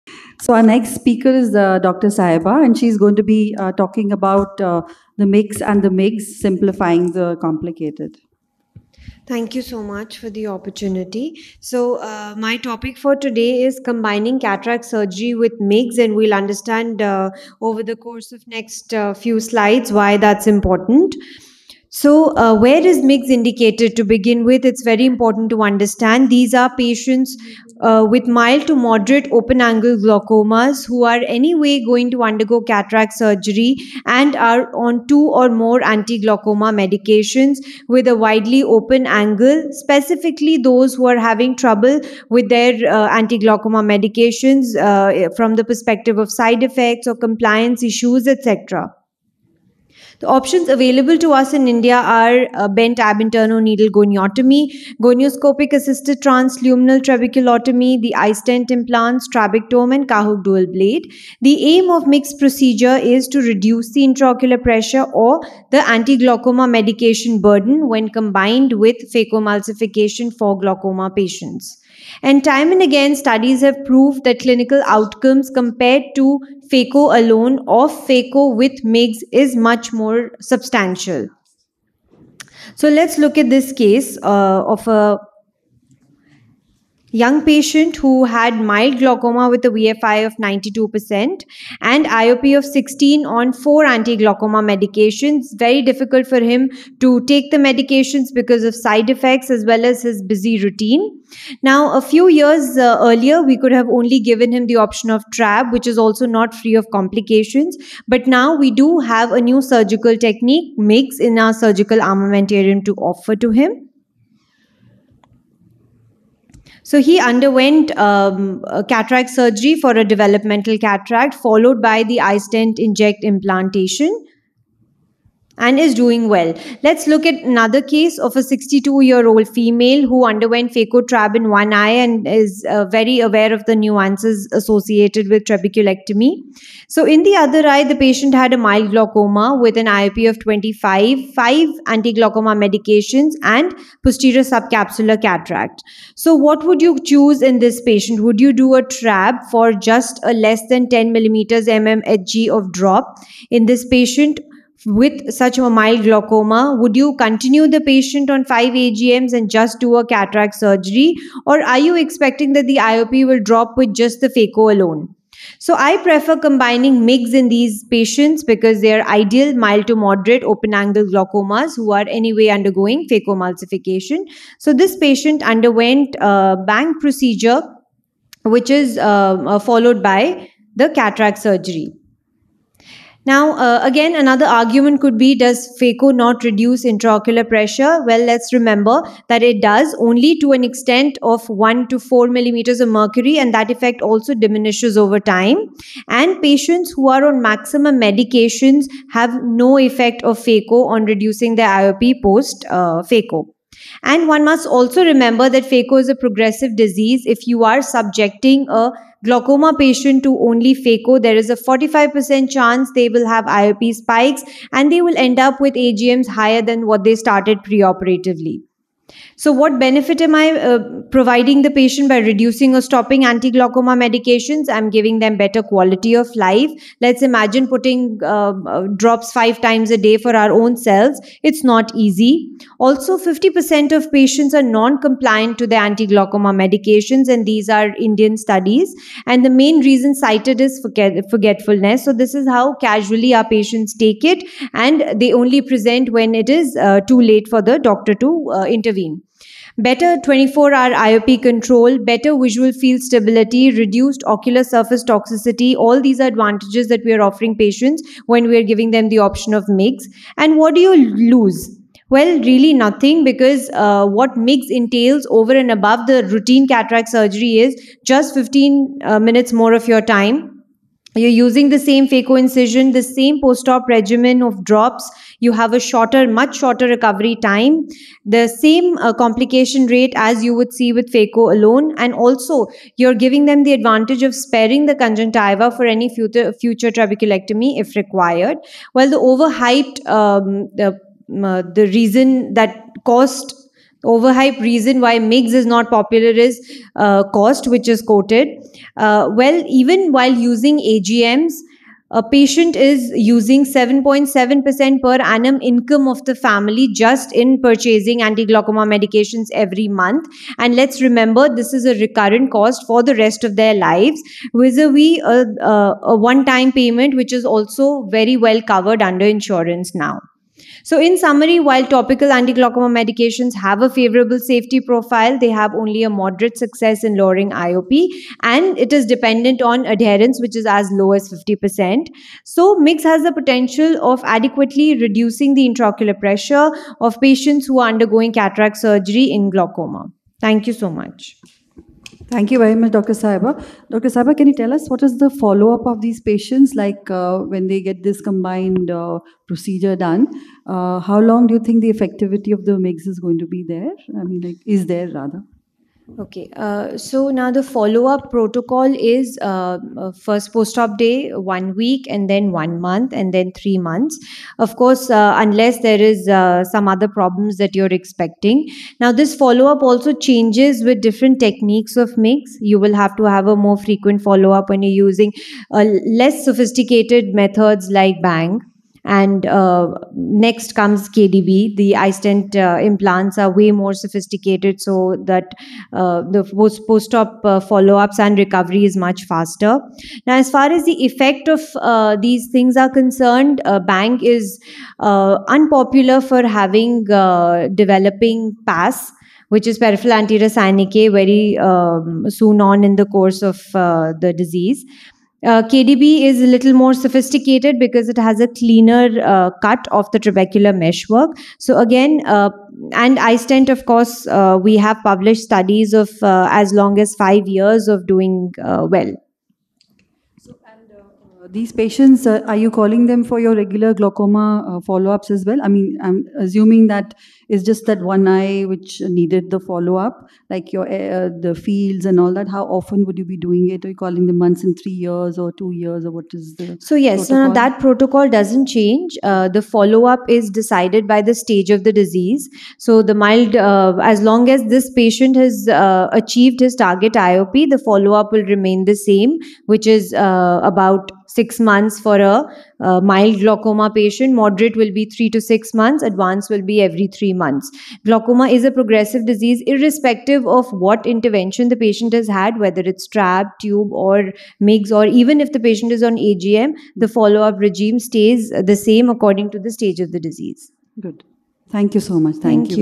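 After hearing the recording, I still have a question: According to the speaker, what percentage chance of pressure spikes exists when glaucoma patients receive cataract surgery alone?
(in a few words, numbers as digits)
45%.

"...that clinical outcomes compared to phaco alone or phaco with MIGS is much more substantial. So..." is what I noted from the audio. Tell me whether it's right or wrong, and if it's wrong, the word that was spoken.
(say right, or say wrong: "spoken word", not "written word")
right.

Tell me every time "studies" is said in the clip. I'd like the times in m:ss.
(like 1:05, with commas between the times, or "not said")
1:13, 3:58, 6:55.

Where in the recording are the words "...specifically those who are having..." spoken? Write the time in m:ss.
0:39.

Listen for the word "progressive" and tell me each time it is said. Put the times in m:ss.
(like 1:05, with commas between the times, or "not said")
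3:26, 7:38.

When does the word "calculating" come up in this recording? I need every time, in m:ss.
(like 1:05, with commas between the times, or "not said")
not said.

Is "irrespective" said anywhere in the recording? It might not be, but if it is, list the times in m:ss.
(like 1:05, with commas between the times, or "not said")
7:39.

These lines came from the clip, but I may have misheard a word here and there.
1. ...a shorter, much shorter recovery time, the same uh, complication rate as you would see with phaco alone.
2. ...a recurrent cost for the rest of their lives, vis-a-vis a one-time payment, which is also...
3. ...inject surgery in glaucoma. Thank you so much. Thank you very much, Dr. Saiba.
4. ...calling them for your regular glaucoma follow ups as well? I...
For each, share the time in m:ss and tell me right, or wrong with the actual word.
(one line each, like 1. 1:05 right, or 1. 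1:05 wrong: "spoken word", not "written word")
1. 4:35 right
2. 5:11 right
3. 5:38 wrong: "cataract", not "inject"
4. 7:02 right.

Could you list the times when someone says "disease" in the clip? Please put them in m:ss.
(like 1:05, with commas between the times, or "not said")
3:26, 6:44, 7:21, 7:39, 7:50.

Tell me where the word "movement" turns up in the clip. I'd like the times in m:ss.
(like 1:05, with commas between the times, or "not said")
not said.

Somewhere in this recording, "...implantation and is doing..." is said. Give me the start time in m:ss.
2:03.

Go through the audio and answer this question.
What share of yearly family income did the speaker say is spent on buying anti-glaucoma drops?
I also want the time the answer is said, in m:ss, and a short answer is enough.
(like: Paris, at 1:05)
7.7%, at 5:03.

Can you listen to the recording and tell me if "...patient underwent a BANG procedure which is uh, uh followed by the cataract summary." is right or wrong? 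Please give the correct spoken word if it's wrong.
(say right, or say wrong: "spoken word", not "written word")
wrong: "surgery", not "summary".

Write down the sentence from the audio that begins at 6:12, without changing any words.
You will have to have a more frequent follow up when you're using uh, less sophisticated methods like Bang.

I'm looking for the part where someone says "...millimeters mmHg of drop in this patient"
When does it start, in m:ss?
2:31.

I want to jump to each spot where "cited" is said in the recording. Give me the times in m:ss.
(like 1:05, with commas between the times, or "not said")
4:00.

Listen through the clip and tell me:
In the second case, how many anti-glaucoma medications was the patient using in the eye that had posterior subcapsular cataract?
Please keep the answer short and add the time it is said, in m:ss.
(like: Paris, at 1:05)
5, at 2:21.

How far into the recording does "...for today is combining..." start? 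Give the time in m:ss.
0:12.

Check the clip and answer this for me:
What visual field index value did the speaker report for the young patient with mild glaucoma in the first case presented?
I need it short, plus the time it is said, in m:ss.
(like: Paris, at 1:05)
92%, at 1:29.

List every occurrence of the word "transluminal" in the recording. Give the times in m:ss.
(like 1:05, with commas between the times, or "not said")
0:56.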